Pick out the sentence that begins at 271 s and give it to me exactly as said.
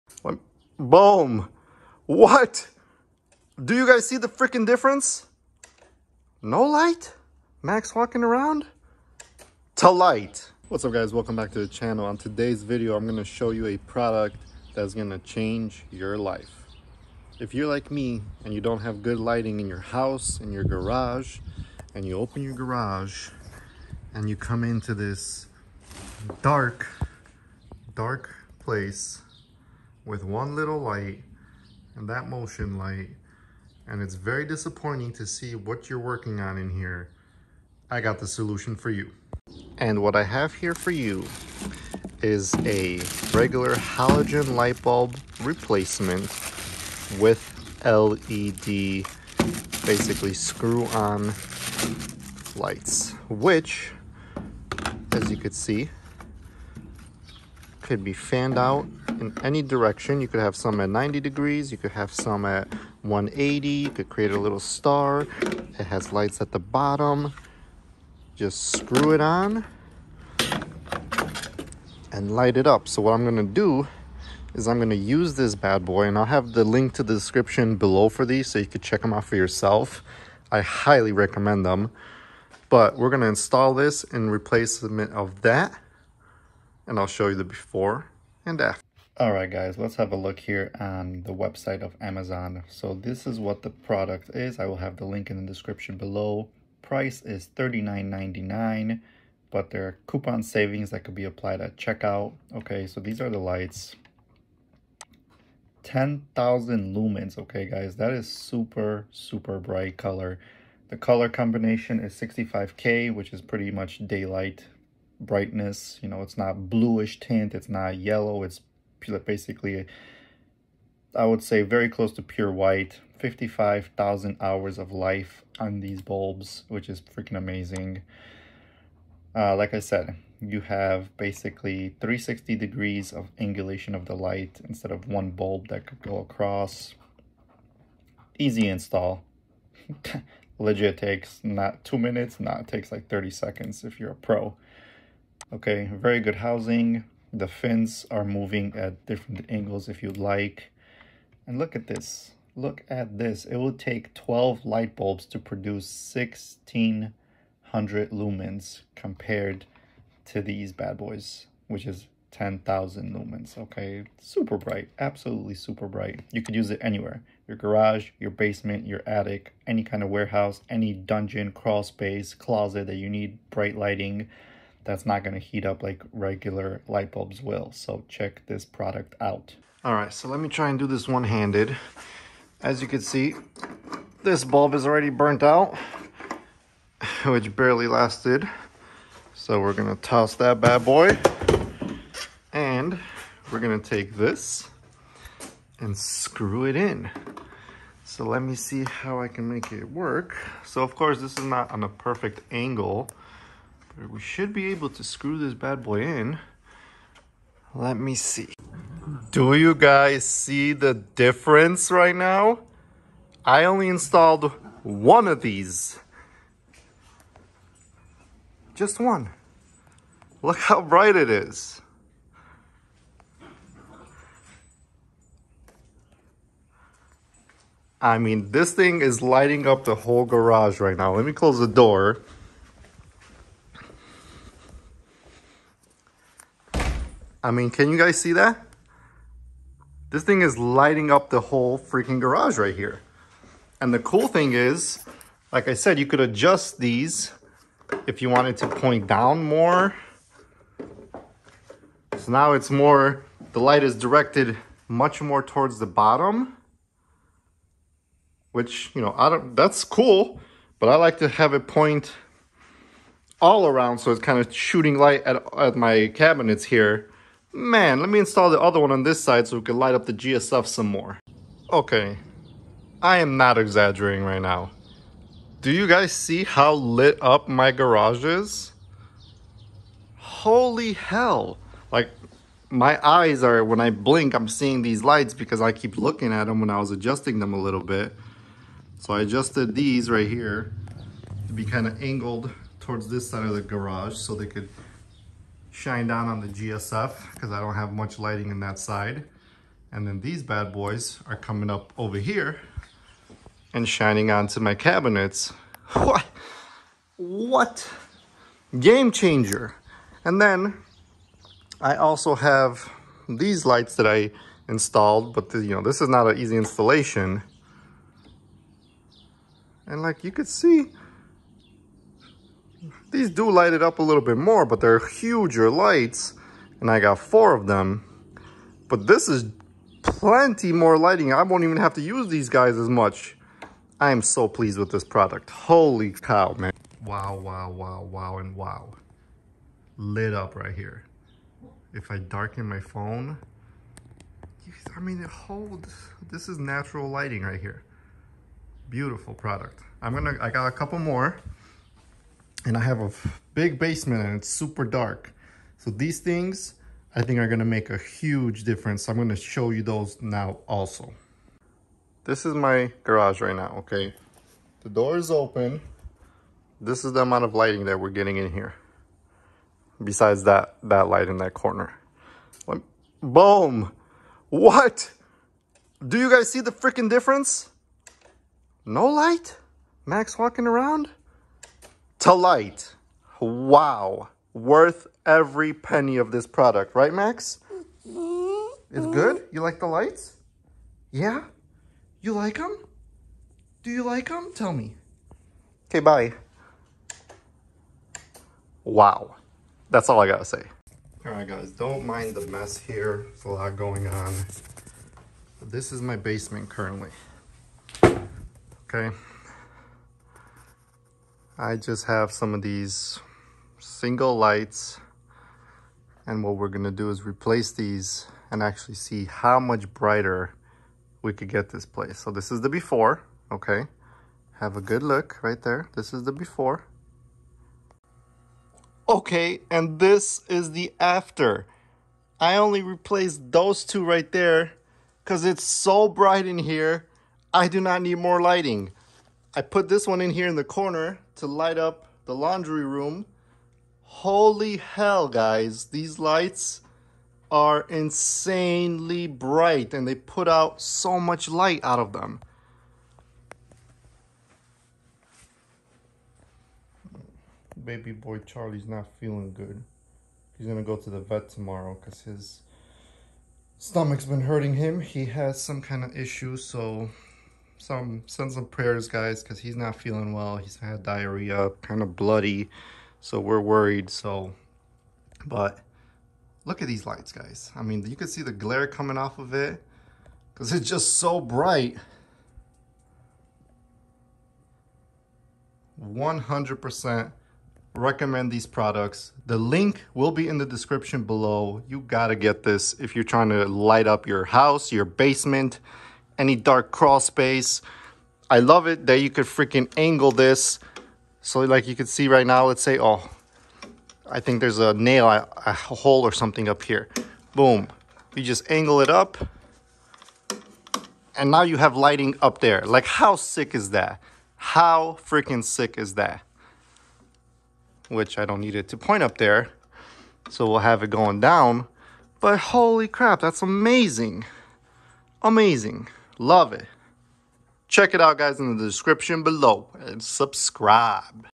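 Okay, I am not exaggerating right now.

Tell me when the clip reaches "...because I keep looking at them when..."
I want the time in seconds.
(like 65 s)
285 s.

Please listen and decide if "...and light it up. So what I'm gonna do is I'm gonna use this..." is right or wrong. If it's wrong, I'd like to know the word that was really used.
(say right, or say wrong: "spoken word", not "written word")
right.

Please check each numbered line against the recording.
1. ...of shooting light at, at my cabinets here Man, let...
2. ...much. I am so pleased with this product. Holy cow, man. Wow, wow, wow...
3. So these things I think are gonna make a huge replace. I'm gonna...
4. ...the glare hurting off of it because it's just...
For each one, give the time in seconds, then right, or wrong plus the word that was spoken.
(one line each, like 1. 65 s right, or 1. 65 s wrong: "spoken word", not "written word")
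1. 264 s right
2. 332 s right
3. 355 s wrong: "difference", not "replace"
4. 478 s wrong: "coming", not "hurting".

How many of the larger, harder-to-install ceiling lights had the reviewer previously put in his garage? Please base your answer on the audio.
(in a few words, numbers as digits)
four.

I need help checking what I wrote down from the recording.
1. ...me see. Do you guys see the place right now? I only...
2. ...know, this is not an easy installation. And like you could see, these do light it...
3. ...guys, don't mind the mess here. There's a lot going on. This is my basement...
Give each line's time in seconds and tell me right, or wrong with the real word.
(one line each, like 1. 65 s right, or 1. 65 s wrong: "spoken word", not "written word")
1. 207 s wrong: "difference", not "place"
2. 315 s right
3. 401 s right.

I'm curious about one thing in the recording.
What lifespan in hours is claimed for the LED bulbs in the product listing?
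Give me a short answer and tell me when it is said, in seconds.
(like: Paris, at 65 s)
55,000 hours, at 123 s.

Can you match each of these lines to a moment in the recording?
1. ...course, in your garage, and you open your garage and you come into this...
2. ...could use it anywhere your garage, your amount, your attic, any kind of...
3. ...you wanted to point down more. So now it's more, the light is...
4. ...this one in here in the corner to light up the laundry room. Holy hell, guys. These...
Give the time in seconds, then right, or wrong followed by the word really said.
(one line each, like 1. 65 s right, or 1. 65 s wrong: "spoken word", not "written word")
1. 19 s wrong: "house", not "course"
2. 166 s wrong: "basement", not "amount"
3. 248 s right
4. 439 s right.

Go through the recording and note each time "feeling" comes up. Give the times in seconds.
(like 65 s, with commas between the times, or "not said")
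459 s, 469 s.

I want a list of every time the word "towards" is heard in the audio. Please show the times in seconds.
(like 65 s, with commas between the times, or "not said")
255 s, 292 s.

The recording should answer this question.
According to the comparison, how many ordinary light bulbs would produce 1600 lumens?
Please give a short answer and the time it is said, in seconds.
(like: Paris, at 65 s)
12, at 154 s.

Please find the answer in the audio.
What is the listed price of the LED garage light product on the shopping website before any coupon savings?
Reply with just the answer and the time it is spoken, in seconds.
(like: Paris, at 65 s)
$39.99, at 97 s.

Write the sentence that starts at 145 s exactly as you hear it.
Okay, very good housing, the fins are moving at different angles if you'd like.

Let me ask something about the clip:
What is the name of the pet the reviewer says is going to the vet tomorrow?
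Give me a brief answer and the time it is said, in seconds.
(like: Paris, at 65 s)
Charlie, at 458 s.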